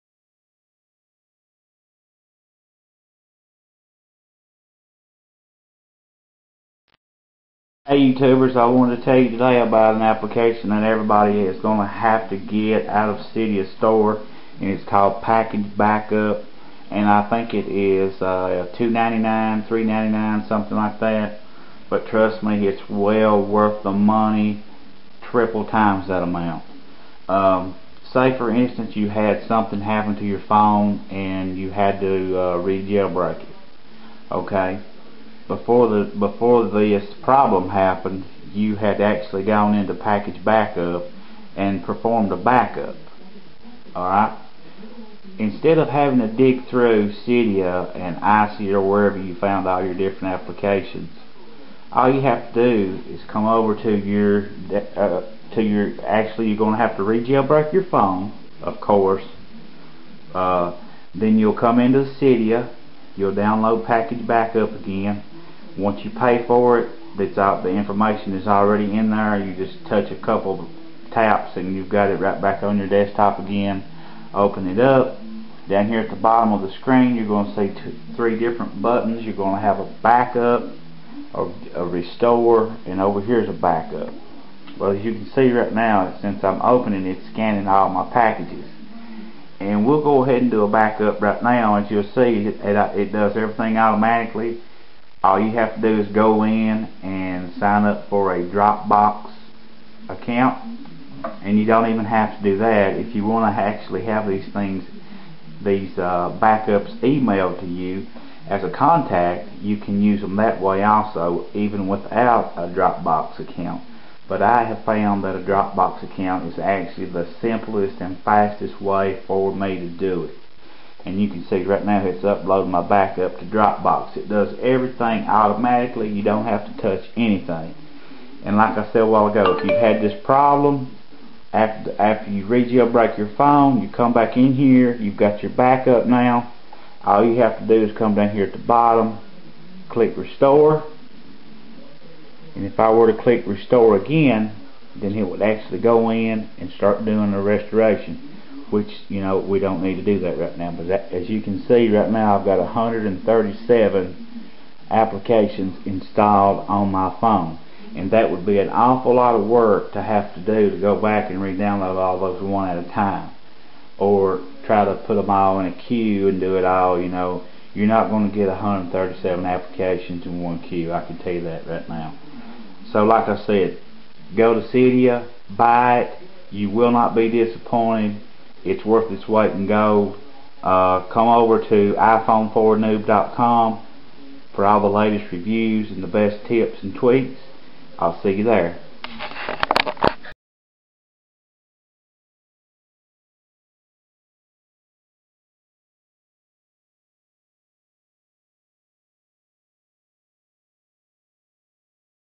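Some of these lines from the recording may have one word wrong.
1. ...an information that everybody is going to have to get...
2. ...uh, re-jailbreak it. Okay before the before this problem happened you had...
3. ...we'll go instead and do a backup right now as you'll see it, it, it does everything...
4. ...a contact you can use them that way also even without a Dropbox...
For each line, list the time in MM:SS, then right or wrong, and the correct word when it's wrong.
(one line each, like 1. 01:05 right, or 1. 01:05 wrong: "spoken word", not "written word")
1. 00:09 wrong: "application", not "information"
2. 00:32 right
3. 01:29 wrong: "ahead", not "instead"
4. 01:48 right.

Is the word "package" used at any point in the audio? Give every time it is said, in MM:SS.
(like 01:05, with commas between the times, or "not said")
00:15, 00:39, 01:03, 01:28.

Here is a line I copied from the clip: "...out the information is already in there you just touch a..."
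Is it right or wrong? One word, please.
right.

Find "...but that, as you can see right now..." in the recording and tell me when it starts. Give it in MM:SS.
02:30.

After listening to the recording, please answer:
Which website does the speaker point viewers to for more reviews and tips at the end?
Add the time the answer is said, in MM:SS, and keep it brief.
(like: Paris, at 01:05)
iPhone4noob.com, at 03:01.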